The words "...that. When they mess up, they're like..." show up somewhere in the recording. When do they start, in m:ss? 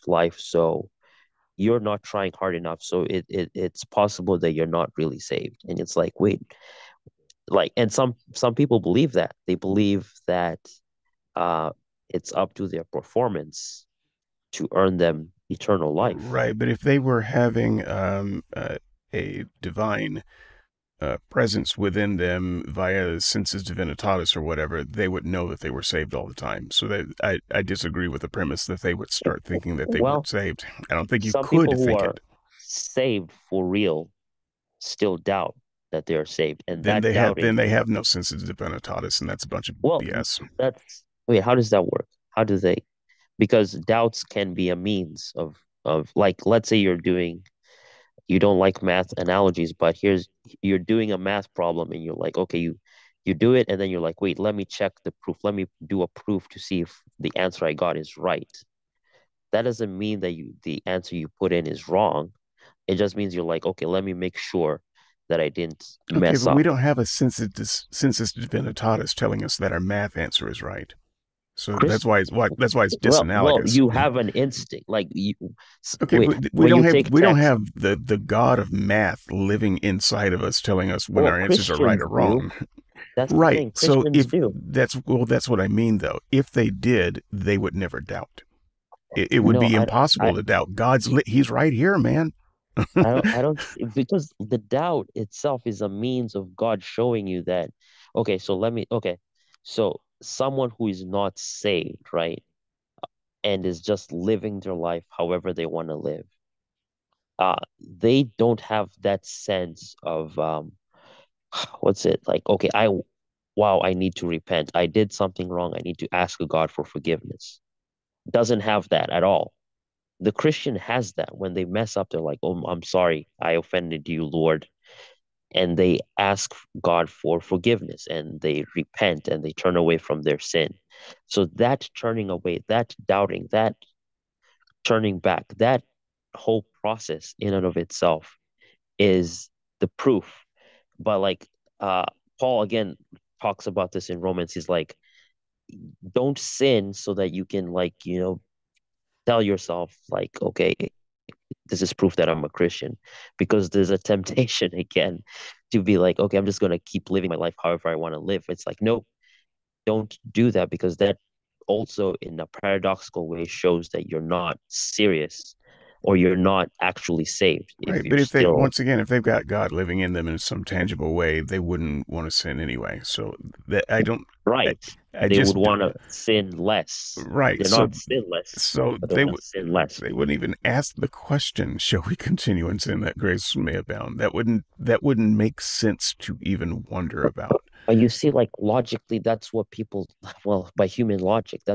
2:01.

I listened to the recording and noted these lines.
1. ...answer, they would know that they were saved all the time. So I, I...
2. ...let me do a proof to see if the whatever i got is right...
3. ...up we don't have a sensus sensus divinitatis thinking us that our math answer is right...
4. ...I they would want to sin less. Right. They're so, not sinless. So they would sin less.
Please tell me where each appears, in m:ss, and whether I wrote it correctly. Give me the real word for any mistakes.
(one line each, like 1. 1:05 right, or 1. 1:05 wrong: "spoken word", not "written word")
1. 0:24 wrong: "whatever", not "answer"
2. 0:55 wrong: "answer", not "whatever"
3. 1:06 wrong: "telling", not "thinking"
4. 2:55 right.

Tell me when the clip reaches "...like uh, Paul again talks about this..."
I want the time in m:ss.
2:21.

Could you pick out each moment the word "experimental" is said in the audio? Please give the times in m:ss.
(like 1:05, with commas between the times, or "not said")
not said.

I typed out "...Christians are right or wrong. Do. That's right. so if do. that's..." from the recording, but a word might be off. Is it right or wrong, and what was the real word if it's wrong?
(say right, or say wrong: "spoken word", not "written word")
right.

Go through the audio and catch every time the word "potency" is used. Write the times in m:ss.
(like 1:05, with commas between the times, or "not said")
not said.